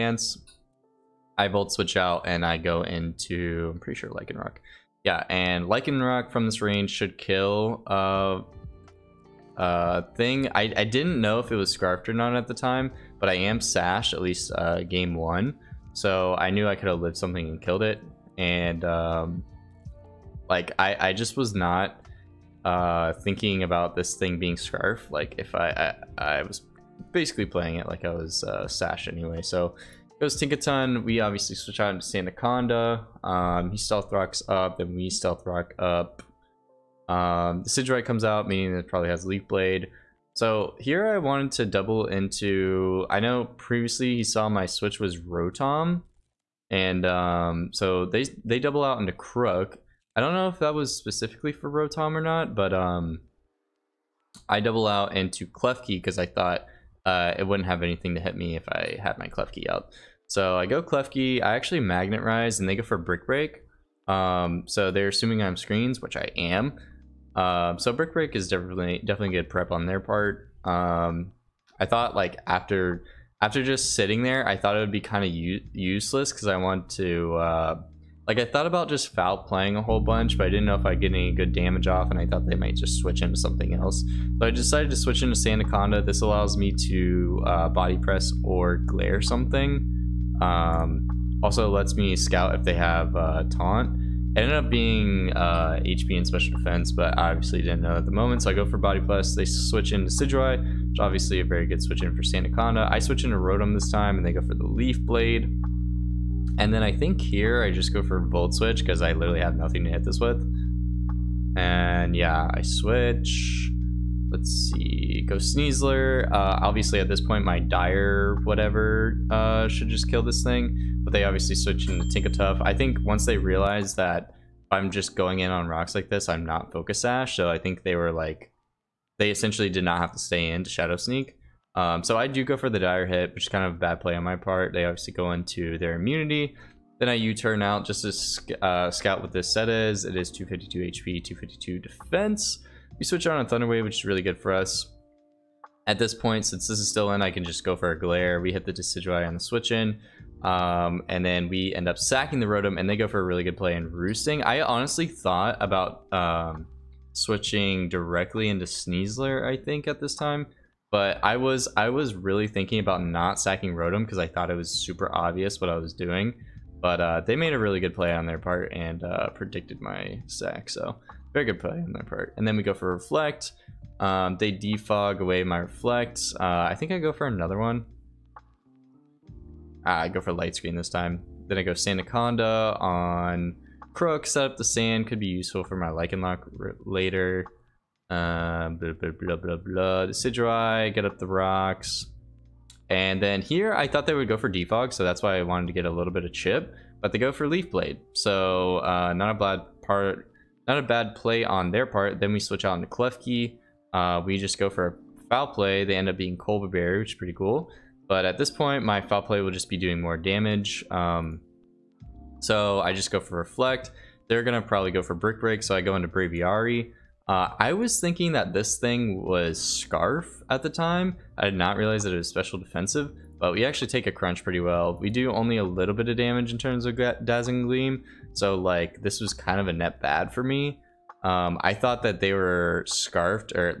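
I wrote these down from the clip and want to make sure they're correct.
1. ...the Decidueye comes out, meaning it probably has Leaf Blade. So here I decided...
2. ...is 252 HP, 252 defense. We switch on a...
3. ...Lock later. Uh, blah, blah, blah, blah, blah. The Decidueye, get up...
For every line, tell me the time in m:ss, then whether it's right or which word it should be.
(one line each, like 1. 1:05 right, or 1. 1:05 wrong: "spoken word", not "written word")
1. 0:37 wrong: "wanted", not "decided"
2. 2:20 right
3. 3:05 right.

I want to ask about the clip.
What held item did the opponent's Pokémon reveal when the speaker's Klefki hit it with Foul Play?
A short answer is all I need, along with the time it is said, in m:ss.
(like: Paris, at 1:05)
Coba Berry, at 3:26.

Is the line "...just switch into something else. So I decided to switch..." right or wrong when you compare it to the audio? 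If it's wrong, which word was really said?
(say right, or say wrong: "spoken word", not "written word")
right.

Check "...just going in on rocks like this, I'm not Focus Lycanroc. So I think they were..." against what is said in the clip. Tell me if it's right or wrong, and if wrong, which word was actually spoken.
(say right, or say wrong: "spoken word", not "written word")
wrong: "Sash", not "Lycanroc".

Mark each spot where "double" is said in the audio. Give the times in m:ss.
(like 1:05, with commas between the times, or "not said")
0:41, 0:48, 0:54.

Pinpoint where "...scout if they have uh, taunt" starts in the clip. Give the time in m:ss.
1:32.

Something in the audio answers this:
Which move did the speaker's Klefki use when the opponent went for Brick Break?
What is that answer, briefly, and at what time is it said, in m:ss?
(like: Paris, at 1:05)
Magnet Rise, at 1:01.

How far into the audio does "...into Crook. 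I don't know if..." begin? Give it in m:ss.
0:48.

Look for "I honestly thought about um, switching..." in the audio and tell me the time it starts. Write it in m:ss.
2:34.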